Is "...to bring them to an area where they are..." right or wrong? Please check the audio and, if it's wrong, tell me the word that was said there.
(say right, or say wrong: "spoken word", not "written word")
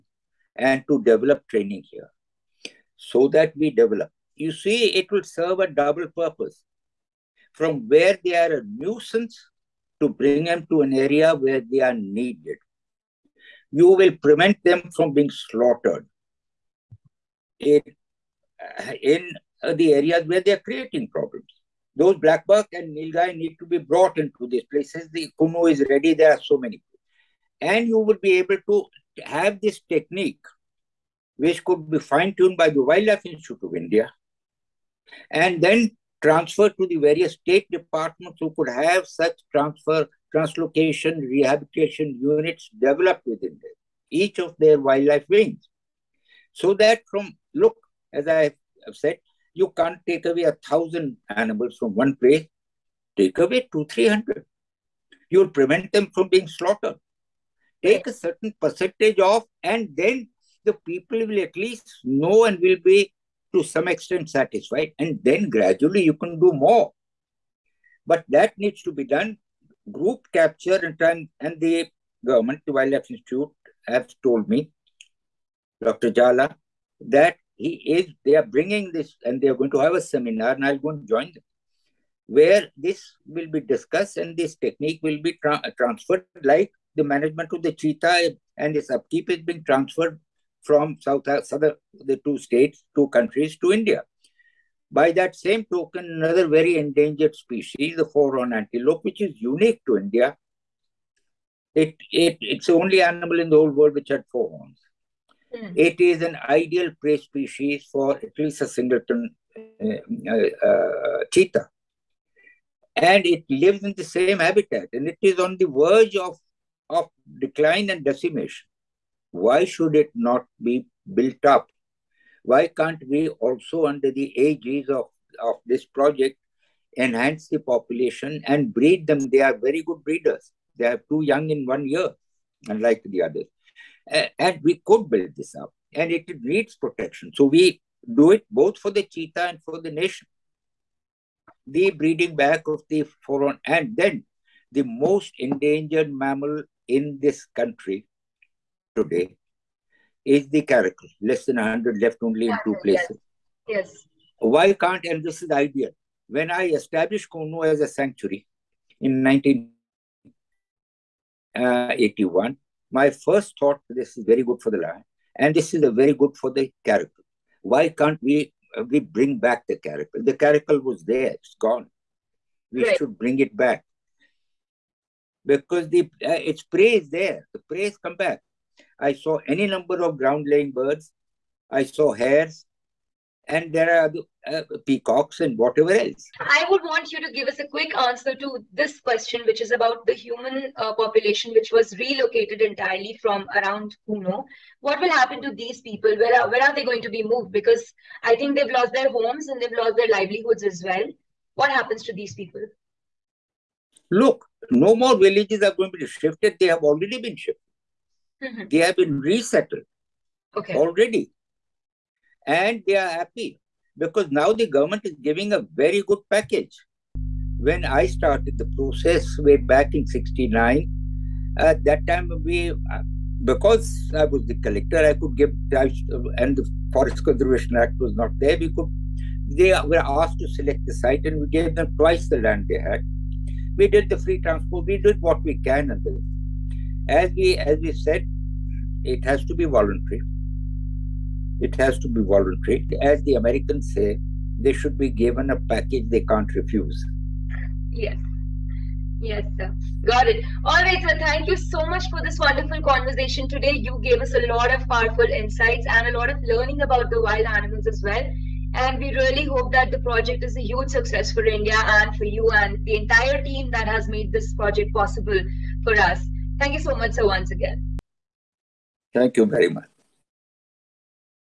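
right.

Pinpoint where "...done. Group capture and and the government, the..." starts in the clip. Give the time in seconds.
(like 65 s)
69 s.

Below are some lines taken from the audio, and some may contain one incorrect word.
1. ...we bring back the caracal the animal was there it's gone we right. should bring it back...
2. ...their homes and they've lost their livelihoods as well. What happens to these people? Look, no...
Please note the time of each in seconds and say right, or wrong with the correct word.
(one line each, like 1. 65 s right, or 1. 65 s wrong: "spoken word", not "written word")
1. 168 s wrong: "caracal", not "animal"
2. 198 s right.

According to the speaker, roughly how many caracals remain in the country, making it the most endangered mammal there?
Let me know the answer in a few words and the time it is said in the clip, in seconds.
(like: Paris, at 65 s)
less than 100, at 151 s.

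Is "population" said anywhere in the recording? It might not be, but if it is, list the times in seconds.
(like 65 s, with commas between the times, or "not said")
127 s, 190 s.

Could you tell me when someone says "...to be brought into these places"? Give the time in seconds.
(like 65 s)
23 s.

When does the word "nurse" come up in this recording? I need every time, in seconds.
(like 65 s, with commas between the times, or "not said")
not said.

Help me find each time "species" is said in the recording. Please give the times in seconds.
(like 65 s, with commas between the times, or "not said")
97 s, 107 s.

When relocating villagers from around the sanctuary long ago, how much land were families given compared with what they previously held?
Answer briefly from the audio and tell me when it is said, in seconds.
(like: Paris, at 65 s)
twice the land, at 231 s.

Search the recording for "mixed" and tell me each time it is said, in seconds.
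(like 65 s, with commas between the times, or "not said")
not said.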